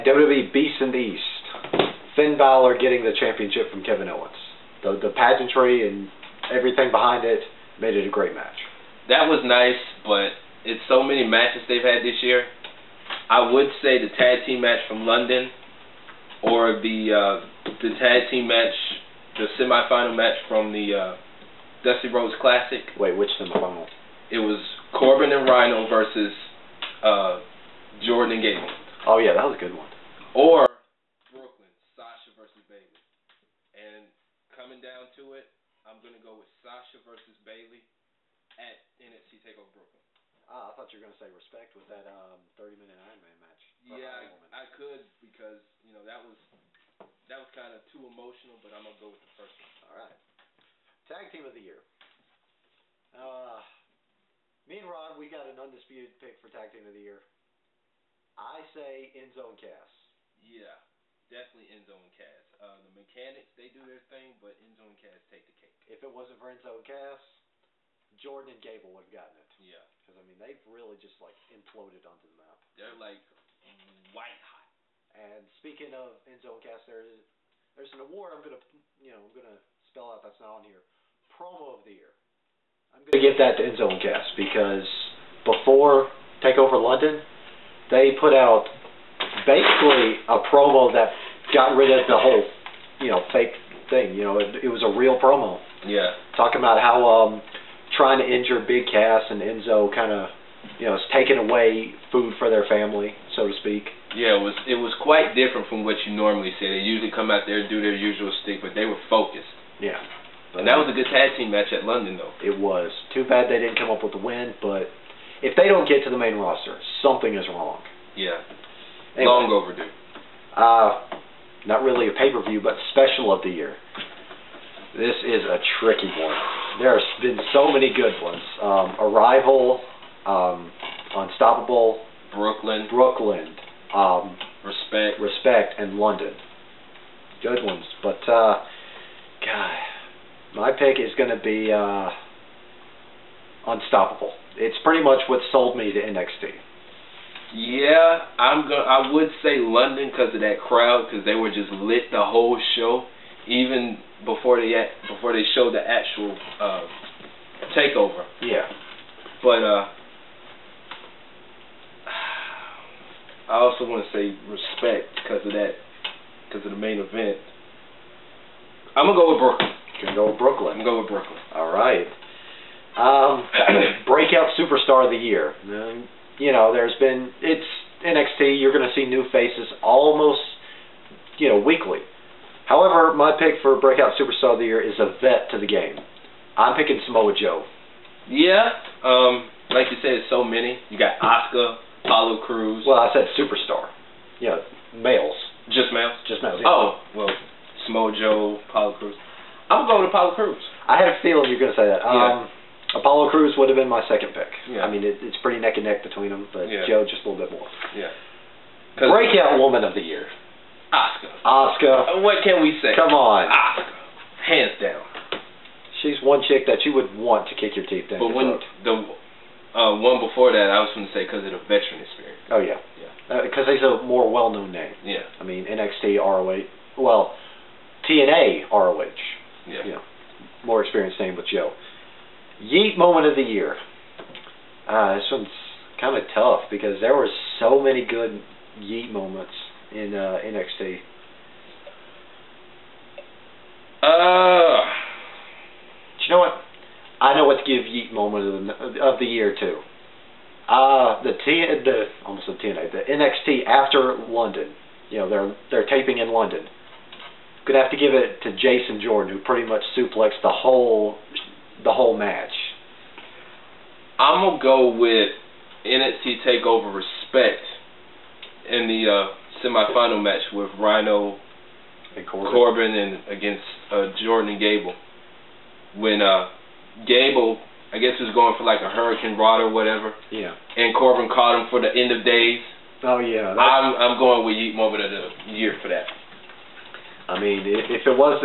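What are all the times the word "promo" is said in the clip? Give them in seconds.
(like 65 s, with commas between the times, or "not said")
81 s, 90 s, 95 s.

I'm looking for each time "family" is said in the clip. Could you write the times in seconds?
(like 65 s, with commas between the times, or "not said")
102 s.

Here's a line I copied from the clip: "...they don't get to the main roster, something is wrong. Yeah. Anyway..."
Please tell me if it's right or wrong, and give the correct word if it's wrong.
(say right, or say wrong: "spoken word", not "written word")
right.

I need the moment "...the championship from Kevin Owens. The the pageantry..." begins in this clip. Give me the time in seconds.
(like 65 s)
3 s.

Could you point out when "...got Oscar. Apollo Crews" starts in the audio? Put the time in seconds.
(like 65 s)
190 s.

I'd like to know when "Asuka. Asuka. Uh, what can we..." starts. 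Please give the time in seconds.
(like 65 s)
210 s.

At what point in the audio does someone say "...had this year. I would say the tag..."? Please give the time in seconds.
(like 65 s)
11 s.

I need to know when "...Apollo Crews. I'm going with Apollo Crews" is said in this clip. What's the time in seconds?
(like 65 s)
198 s.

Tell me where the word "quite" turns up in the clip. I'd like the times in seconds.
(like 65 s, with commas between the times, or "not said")
105 s.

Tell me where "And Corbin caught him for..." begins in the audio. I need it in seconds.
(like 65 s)
280 s.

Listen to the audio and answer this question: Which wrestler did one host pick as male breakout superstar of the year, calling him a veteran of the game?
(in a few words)
Samoa Joe.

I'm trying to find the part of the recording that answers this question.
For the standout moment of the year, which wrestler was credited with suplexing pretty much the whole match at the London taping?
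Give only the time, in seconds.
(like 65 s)
258 s.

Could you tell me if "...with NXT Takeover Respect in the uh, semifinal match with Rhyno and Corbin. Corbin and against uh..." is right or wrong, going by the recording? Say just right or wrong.
right.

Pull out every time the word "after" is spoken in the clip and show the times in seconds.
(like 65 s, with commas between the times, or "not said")
253 s.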